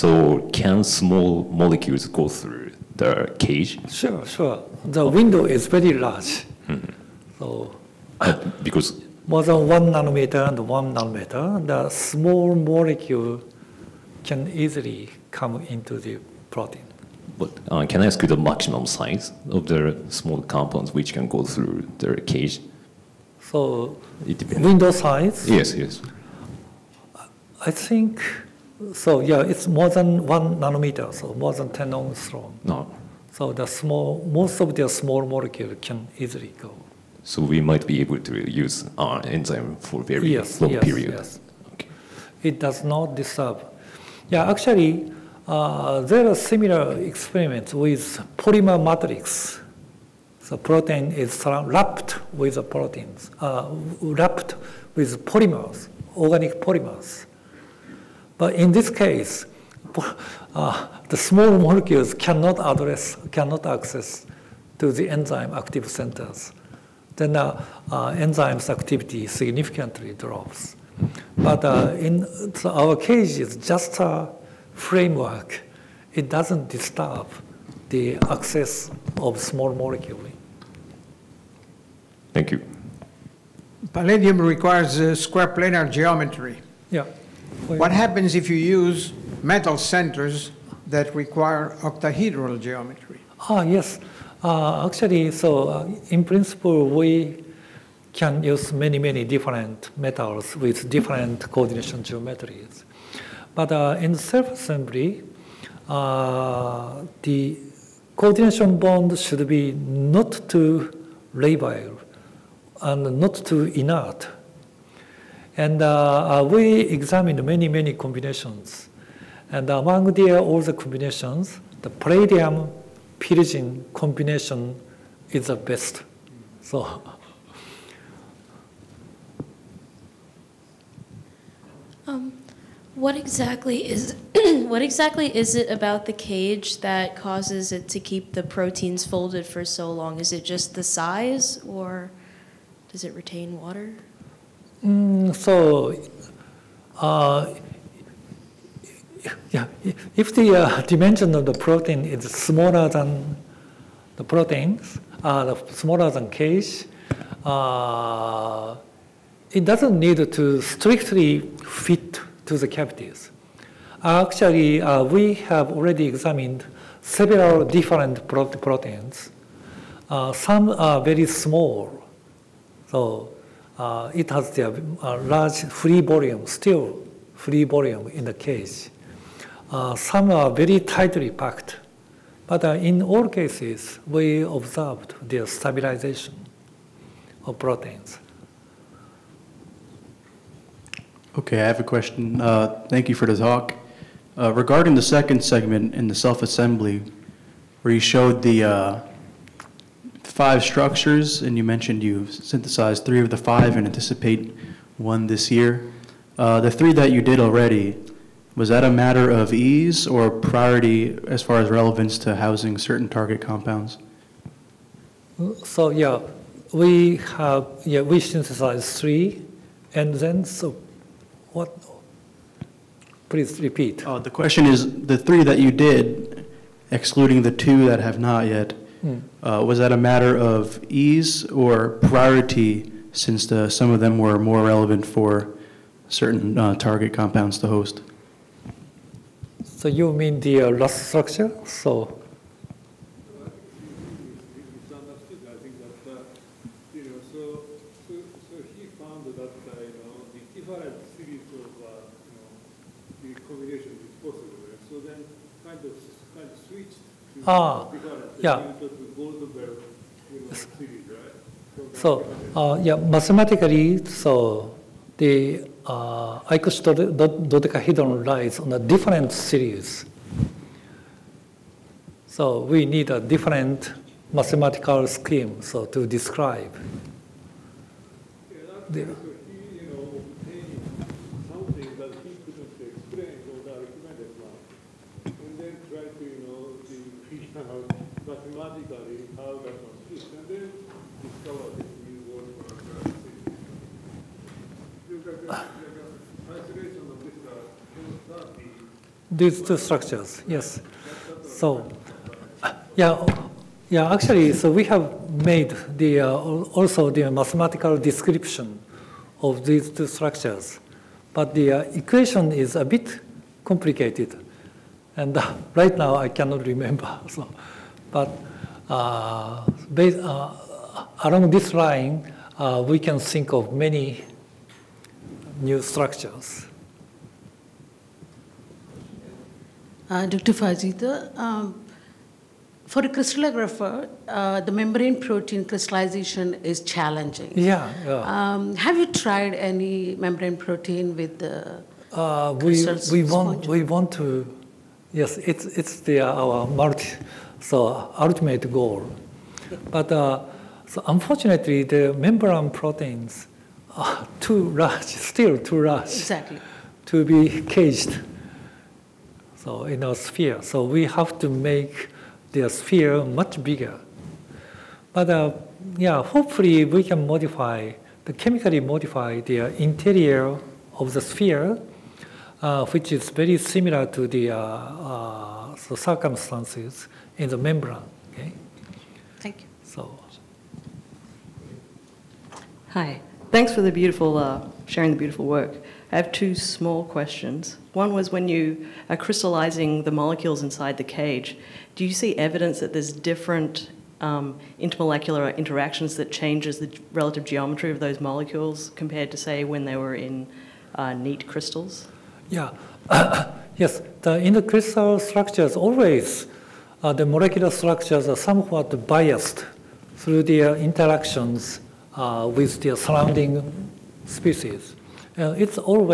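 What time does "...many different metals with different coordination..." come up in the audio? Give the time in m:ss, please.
1:38.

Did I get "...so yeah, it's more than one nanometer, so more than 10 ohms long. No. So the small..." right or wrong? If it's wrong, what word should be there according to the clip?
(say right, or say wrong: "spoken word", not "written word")
right.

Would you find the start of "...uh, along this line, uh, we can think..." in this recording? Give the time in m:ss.
5:20.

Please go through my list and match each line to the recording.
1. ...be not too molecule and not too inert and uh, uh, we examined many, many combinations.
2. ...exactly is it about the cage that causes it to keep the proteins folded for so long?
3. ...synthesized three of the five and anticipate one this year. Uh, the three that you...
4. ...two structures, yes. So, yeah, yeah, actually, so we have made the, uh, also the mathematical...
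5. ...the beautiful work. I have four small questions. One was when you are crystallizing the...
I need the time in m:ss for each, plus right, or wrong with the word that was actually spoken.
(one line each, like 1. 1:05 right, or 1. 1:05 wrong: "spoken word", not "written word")
1. 1:49 wrong: "labile", not "molecule"
2. 2:14 right
3. 3:22 right
4. 4:59 right
5. 6:25 wrong: "two", not "four".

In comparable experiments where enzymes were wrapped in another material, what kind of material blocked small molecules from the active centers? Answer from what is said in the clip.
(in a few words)
organic polymers.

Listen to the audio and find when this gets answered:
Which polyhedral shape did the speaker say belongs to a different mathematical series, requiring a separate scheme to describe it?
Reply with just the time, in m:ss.
4:26.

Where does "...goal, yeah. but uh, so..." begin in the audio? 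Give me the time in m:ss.
5:48.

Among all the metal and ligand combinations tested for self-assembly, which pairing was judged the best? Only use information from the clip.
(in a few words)
palladium pyrazine.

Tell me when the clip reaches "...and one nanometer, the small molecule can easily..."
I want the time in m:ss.
0:10.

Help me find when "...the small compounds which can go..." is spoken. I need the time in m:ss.
0:19.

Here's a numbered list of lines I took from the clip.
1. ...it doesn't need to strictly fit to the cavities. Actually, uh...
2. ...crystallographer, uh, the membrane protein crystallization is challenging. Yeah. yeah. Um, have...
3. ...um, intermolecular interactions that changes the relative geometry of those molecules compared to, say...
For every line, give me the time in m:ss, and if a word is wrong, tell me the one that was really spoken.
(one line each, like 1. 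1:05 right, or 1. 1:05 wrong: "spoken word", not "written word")
1. 2:39 right
2. 5:33 right
3. 6:34 right.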